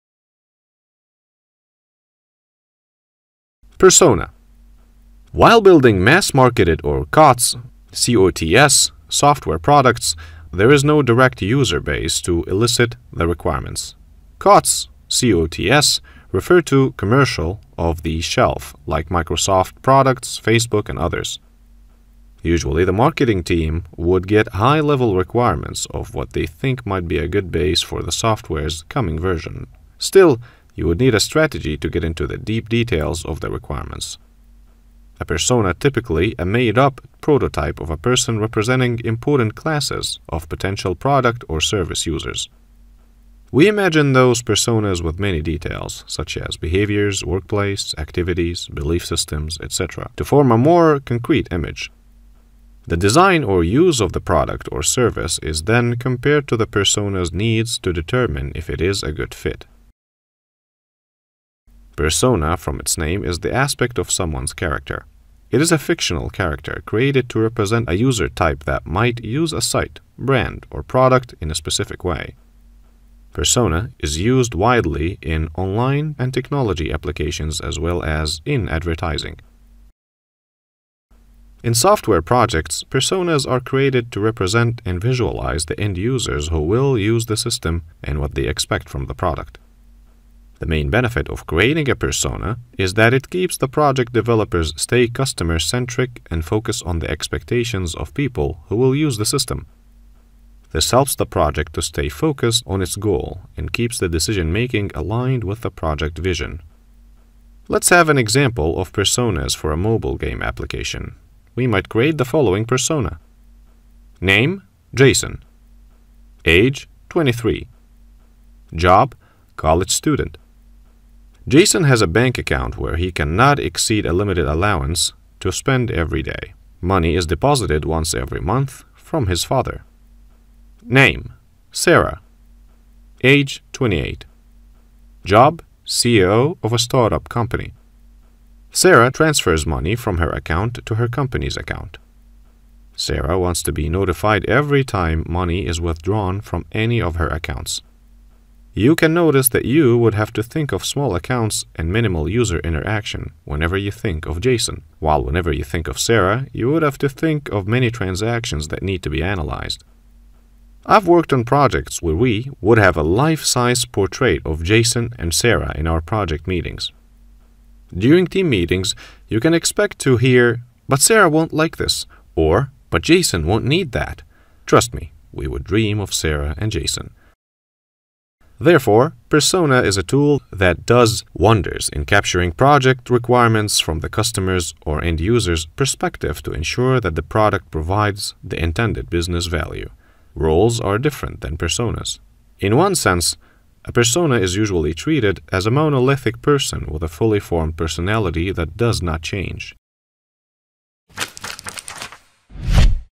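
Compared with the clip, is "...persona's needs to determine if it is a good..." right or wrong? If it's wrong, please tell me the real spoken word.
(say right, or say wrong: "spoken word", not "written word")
right.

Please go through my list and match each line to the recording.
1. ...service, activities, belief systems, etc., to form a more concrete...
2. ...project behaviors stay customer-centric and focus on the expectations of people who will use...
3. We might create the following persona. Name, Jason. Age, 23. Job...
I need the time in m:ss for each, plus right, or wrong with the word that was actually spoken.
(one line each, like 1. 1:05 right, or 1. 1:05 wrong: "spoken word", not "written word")
1. 0:47 wrong: "workplace", not "service"
2. 1:33 wrong: "developers", not "behaviors"
3. 1:51 right.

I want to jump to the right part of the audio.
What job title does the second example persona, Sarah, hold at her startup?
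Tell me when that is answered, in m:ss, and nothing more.
2:15.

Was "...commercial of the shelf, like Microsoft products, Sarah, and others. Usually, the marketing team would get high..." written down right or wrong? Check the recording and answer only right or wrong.
wrong.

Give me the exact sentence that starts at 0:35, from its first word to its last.
A persona typically a made-up prototype of a person representing important classes of potential product or service users.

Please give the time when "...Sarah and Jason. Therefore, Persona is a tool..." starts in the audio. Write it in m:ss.
2:56.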